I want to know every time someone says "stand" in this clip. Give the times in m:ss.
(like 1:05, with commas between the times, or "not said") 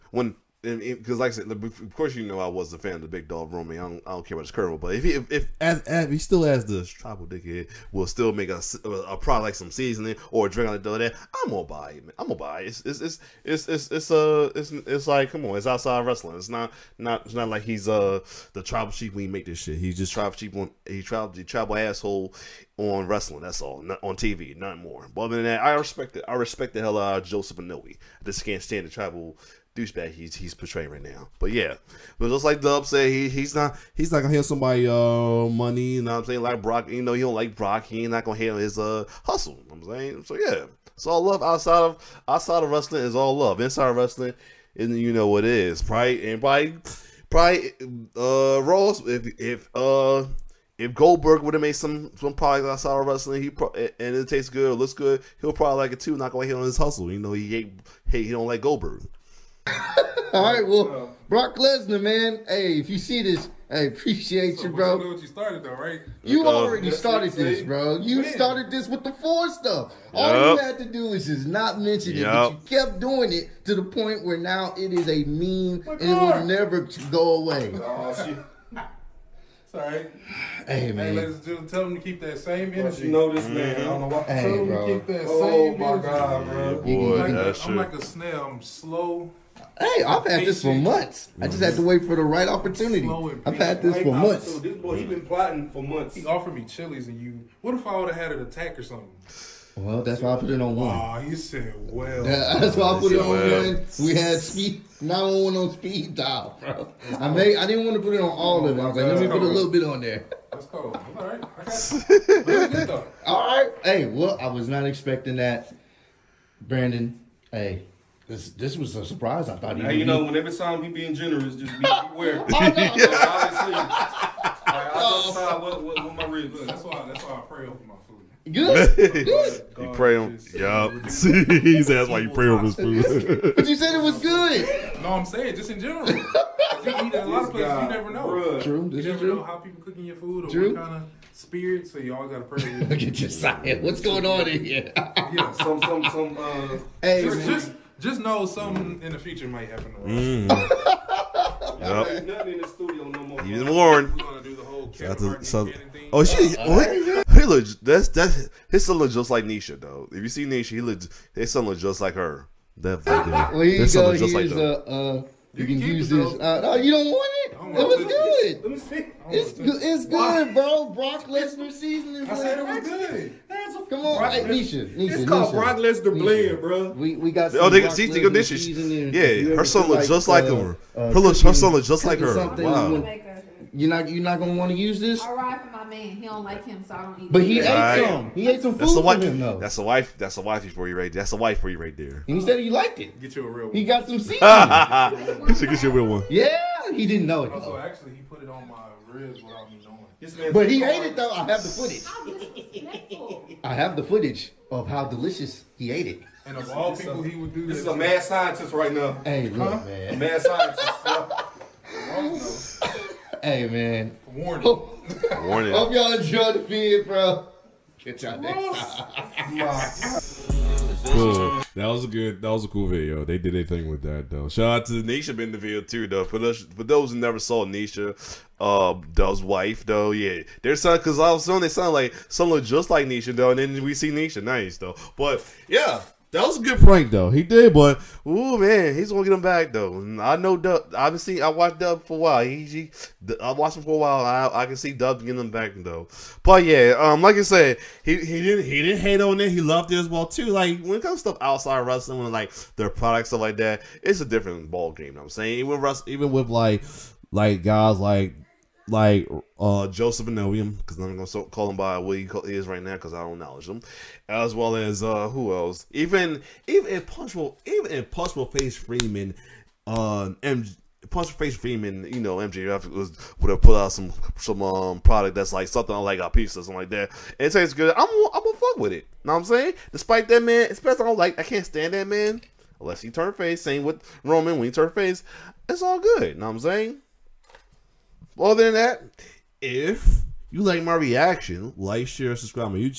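0:28, 4:41.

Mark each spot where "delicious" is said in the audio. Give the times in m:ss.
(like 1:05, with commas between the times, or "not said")
3:25.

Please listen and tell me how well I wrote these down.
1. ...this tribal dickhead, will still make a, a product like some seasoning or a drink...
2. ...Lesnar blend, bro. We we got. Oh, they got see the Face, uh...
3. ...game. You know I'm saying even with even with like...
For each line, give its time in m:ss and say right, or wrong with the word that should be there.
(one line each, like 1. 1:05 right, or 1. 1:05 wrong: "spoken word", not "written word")
1. 0:06 right
2. 2:55 wrong: "Yeah", not "Face"
3. 4:14 right.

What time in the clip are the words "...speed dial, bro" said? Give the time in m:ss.
1:45.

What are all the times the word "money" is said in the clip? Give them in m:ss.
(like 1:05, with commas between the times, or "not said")
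0:35.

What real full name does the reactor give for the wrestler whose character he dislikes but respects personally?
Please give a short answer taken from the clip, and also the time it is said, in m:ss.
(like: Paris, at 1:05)
Joseph Anoa'i, at 0:27.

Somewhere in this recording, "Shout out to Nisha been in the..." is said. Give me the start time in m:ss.
3:44.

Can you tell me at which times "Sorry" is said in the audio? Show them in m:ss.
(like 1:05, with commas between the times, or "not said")
1:19.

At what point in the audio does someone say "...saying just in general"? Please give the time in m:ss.
2:15.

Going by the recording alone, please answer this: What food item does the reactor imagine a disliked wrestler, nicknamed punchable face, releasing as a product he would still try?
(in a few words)
pizza.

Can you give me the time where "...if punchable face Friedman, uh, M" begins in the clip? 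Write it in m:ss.
4:27.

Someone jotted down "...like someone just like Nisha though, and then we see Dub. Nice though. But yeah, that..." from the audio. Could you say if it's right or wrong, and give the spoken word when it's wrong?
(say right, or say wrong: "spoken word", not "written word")
wrong: "Nisha", not "Dub".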